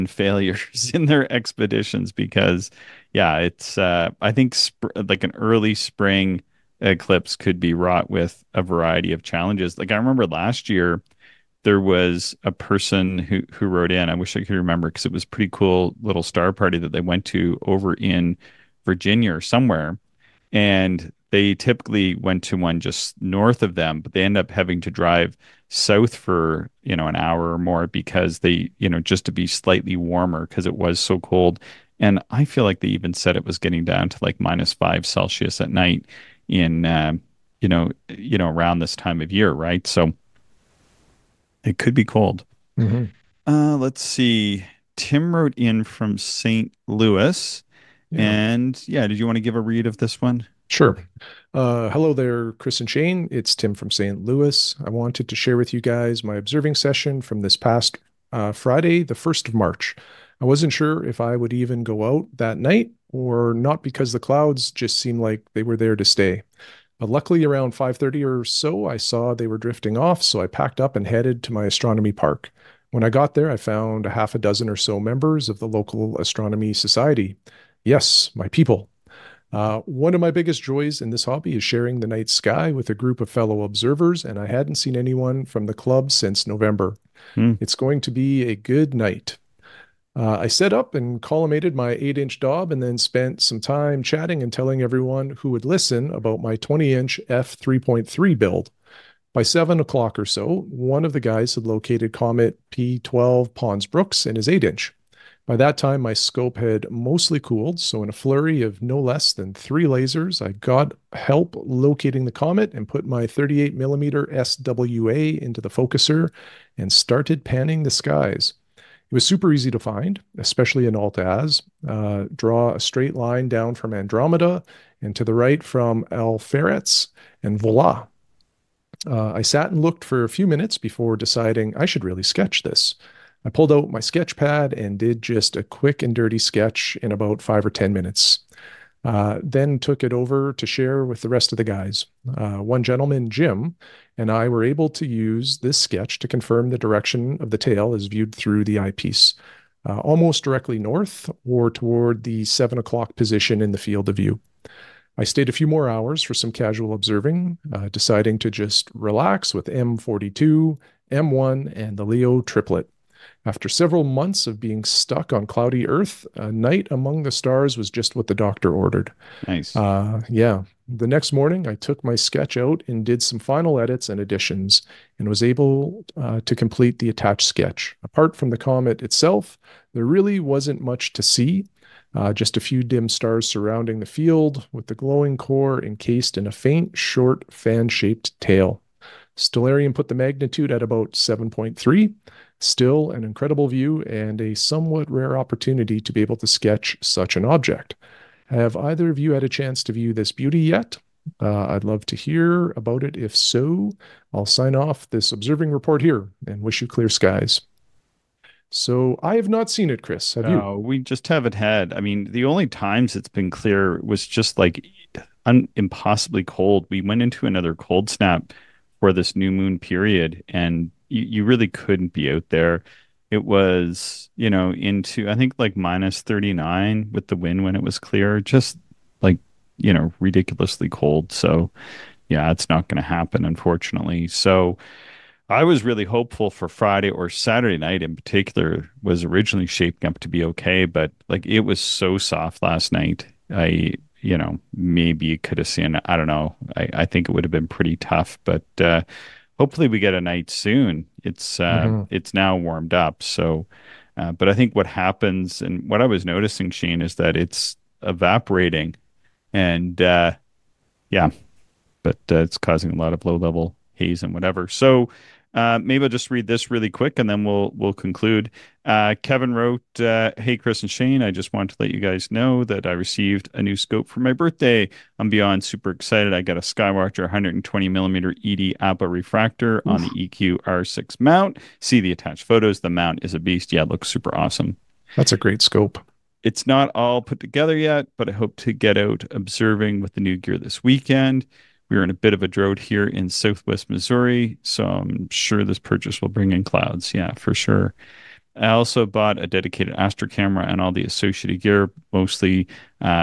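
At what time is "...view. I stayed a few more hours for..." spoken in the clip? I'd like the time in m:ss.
2:34.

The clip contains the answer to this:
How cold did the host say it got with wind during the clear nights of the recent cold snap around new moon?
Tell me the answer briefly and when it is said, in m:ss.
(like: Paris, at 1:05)
minus 39, at 3:45.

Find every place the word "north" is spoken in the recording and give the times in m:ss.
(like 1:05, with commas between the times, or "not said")
0:23, 2:30.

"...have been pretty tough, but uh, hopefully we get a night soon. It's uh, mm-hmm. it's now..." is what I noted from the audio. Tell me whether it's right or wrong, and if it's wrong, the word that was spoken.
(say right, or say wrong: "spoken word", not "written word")
right.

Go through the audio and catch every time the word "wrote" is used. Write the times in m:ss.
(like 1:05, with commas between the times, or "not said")
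0:13, 0:45, 4:29.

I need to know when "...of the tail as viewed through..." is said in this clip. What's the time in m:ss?
2:27.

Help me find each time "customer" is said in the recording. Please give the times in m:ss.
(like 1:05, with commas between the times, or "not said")
not said.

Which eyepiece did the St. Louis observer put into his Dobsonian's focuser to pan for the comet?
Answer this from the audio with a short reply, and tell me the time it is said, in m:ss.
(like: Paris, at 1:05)
38 millimeter SWA, at 1:53.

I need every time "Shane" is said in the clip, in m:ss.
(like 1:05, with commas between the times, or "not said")
0:52, 4:16, 4:30.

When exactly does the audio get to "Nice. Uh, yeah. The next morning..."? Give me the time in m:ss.
2:49.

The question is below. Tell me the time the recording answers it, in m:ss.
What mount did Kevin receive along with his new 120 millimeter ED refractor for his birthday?
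4:40.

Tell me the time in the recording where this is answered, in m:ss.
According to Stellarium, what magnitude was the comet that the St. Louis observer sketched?
3:11.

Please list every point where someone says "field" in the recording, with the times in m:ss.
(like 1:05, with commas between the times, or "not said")
2:33, 3:04.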